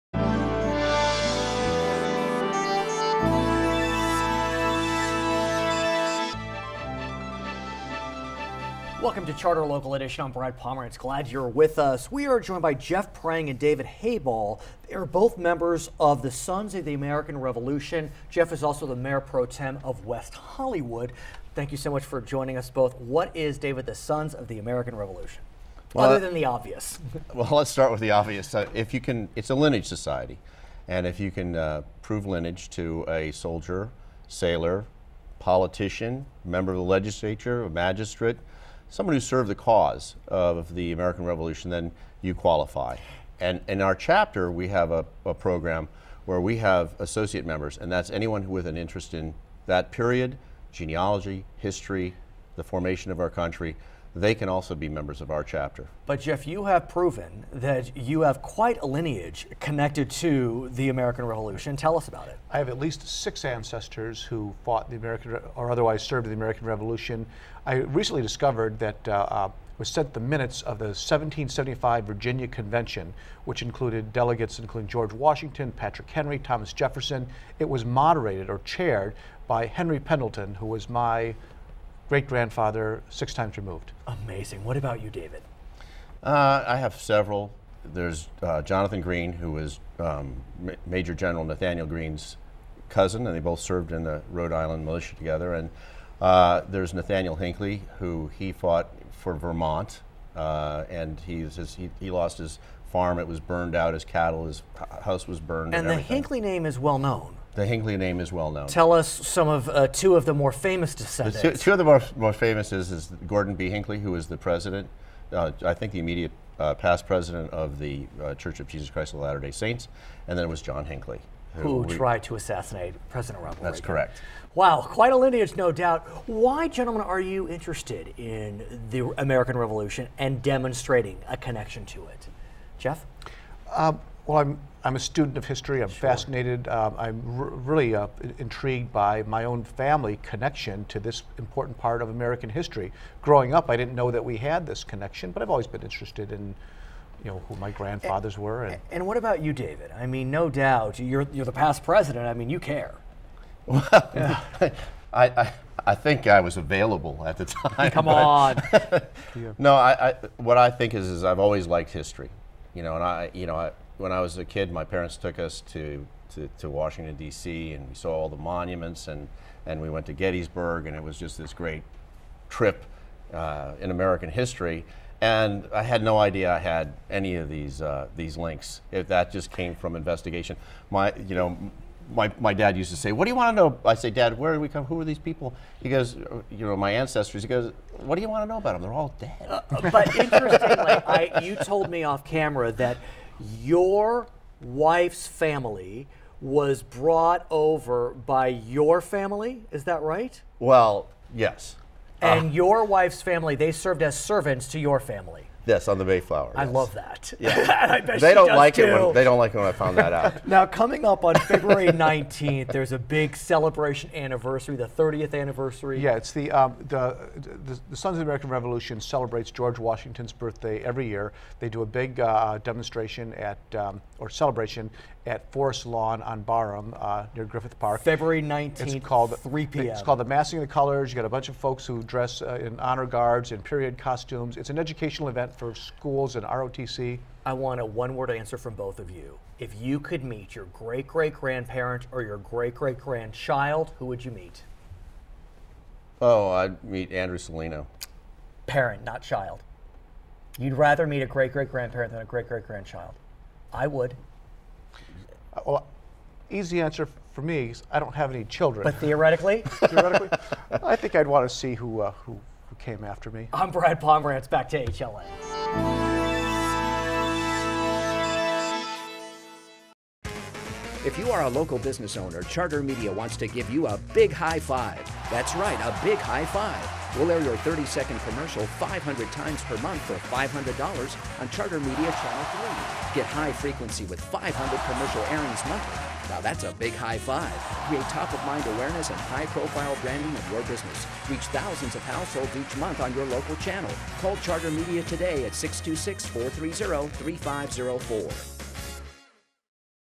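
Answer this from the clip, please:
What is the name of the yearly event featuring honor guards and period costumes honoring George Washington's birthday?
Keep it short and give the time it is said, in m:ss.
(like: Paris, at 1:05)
Massing of the Colors, at 3:50.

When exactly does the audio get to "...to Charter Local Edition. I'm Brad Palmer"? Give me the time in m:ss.
0:09.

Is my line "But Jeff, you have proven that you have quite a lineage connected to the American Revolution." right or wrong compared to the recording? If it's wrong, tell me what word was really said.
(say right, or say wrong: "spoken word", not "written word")
right.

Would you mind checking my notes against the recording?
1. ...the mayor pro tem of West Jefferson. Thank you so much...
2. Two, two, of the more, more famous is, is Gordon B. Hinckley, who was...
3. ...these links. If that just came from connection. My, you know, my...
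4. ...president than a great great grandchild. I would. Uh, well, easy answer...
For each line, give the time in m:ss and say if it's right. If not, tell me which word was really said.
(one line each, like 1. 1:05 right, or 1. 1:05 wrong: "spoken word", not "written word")
1. 0:18 wrong: "Hollywood", not "Jefferson"
2. 1:51 right
3. 2:58 wrong: "investigation", not "connection"
4. 4:11 wrong: "grandparent", not "president".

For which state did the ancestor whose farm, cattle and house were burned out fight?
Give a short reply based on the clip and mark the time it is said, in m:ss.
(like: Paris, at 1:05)
Vermont, at 1:39.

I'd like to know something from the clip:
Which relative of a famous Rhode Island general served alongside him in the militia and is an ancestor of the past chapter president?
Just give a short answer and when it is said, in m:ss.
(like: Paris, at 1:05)
Jonathan Green, at 1:28.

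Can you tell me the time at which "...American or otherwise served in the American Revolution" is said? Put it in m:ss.
1:04.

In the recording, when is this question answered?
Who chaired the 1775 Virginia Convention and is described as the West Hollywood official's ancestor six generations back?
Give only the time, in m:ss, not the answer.
1:19.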